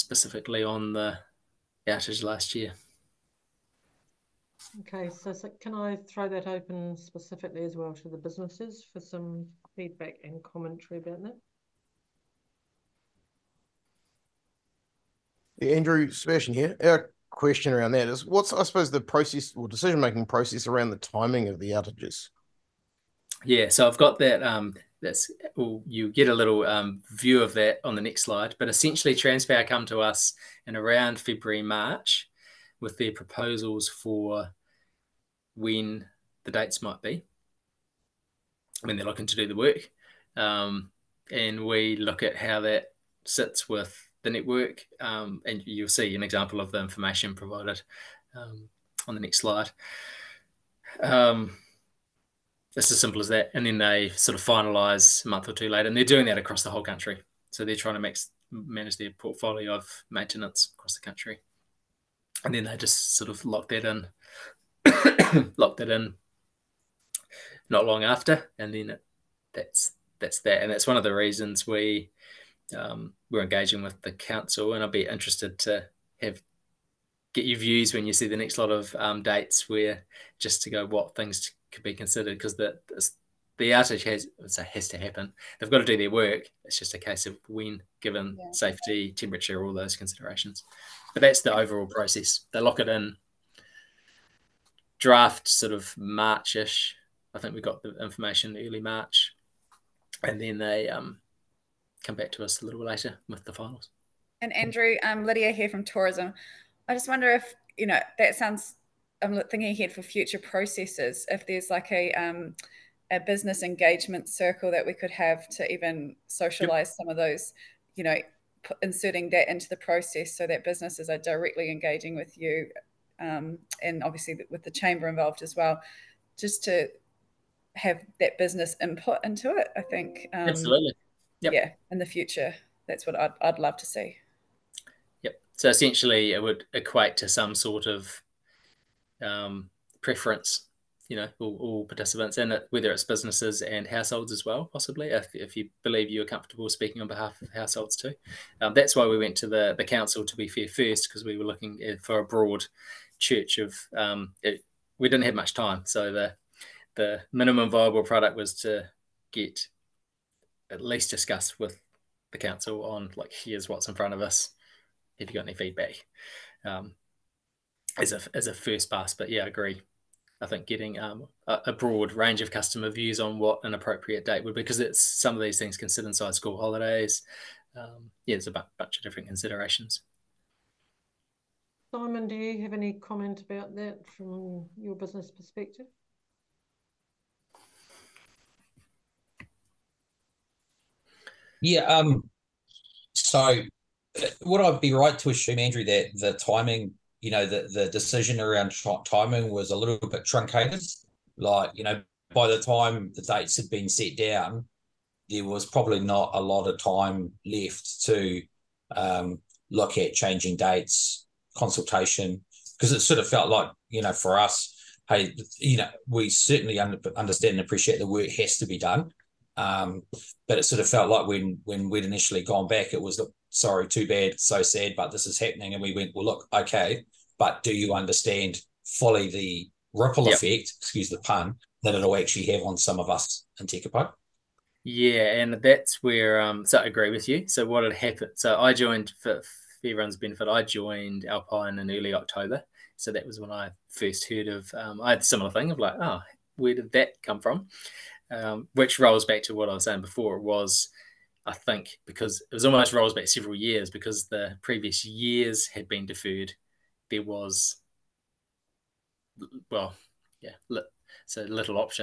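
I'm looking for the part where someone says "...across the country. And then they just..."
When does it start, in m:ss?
1:00.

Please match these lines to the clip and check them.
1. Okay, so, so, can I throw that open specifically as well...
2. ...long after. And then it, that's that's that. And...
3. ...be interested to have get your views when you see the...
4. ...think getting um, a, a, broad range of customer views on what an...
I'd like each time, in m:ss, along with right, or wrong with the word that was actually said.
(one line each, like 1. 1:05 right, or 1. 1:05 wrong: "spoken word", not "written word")
1. 0:04 right
2. 1:07 right
3. 1:14 right
4. 2:50 right.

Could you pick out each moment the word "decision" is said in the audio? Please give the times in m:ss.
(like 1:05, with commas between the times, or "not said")
0:19, 3:17.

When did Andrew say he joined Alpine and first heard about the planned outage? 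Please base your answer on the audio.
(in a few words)
early October.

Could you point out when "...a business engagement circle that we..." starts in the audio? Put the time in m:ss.
1:53.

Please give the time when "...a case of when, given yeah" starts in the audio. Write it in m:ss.
1:26.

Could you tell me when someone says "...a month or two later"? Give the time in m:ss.
0:55.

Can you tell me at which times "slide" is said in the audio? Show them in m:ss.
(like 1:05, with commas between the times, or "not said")
0:28, 0:49.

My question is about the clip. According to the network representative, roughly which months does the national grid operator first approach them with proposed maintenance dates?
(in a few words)
February, March.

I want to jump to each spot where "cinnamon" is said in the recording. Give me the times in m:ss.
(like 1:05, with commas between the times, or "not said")
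not said.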